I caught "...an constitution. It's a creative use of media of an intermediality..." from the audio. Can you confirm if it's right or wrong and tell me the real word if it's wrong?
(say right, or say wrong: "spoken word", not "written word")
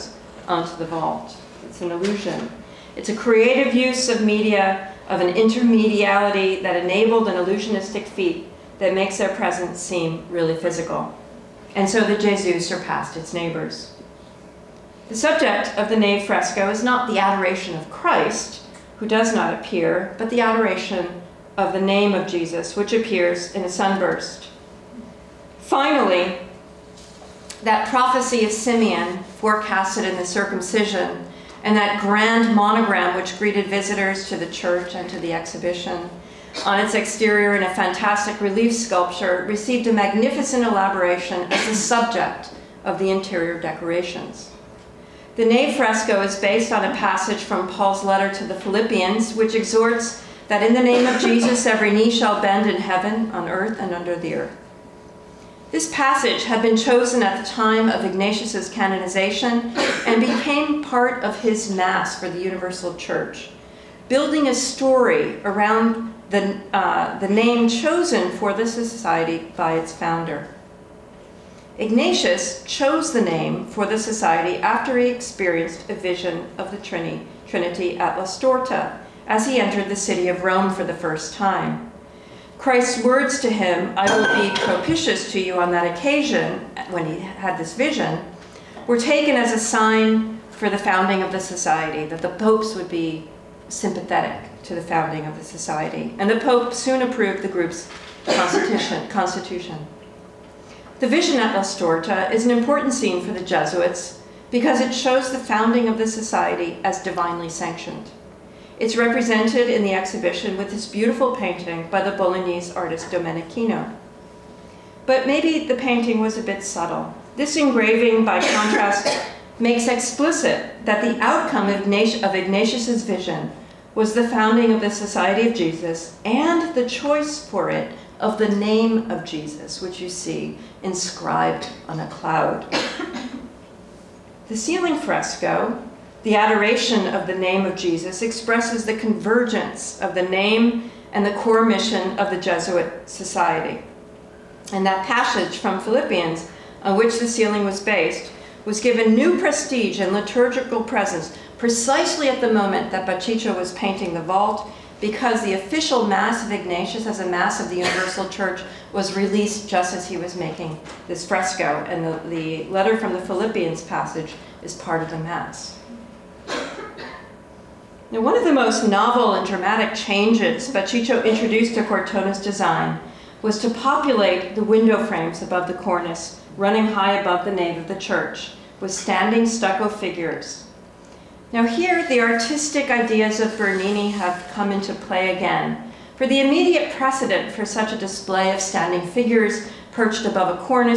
wrong: "illusion", not "constitution".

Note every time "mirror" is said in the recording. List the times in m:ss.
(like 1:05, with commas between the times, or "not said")
not said.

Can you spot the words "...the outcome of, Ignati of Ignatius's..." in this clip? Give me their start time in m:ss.
2:01.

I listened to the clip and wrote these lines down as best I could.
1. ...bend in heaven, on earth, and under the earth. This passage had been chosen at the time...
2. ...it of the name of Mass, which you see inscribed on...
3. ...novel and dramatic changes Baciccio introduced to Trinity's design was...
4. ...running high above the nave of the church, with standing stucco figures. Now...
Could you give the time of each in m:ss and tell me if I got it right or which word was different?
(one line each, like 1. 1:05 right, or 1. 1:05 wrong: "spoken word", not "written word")
1. 0:52 right
2. 2:07 wrong: "Jesus", not "Mass"
3. 2:48 wrong: "Cortona", not "Trinity"
4. 2:56 right.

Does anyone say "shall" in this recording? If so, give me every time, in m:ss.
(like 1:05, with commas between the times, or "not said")
0:52.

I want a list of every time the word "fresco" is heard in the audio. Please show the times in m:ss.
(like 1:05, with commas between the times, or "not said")
0:16, 0:45, 2:14, 2:41.